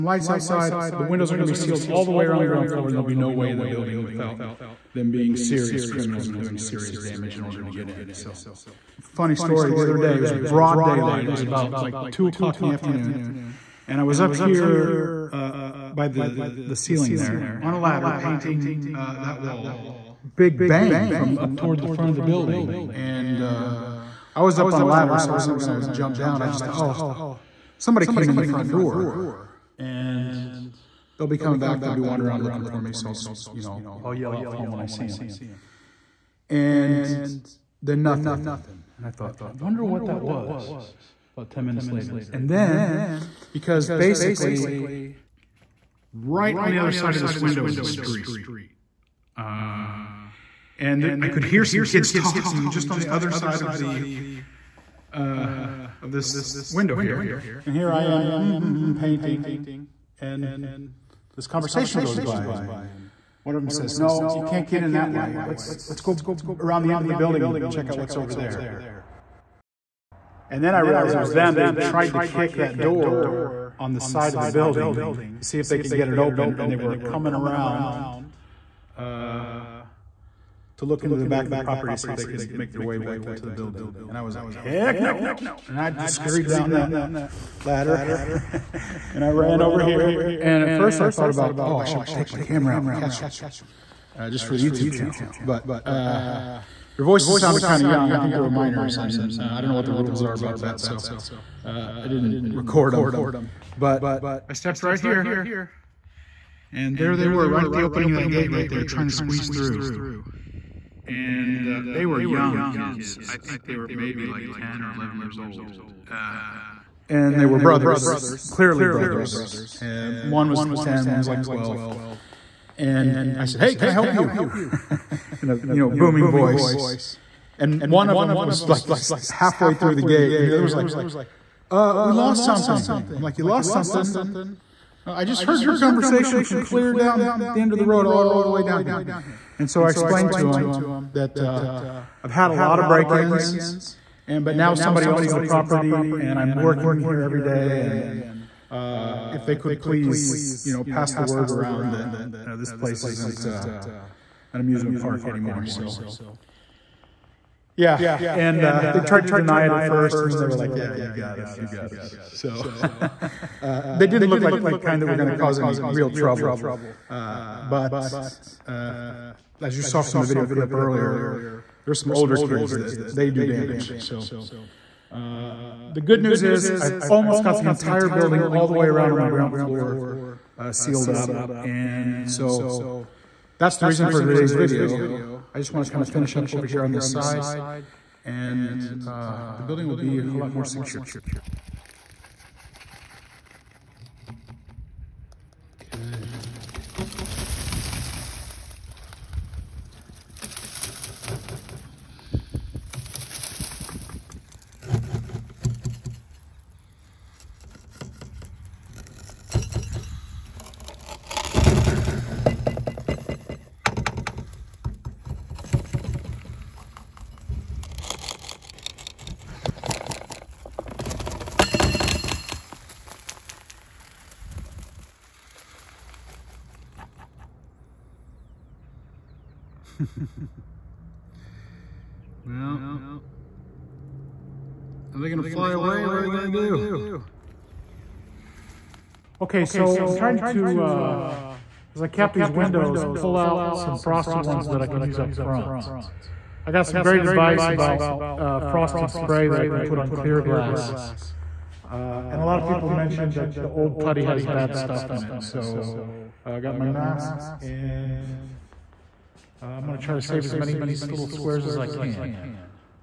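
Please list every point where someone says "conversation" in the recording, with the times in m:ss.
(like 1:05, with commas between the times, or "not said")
1:01, 2:15.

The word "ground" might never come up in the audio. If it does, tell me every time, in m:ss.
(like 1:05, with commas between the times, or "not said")
0:02, 2:59.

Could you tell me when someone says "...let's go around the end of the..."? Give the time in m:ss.
1:05.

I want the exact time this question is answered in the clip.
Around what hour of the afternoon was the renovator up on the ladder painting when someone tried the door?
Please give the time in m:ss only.
0:12.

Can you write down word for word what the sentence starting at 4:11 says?
Uh, and a lot of people mentioned that the old putty has bad stuff in it.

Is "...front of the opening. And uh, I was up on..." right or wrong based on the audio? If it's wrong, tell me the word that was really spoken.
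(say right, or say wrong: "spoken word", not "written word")
wrong: "building", not "opening".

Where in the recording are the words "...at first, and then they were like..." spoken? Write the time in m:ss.
2:39.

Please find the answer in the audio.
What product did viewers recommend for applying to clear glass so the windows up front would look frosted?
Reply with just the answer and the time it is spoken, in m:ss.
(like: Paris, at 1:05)
frosted spray, at 4:08.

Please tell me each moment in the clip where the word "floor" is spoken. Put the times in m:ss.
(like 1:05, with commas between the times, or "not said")
0:02, 2:59.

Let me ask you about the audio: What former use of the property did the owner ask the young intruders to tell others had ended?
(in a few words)
an amusement park.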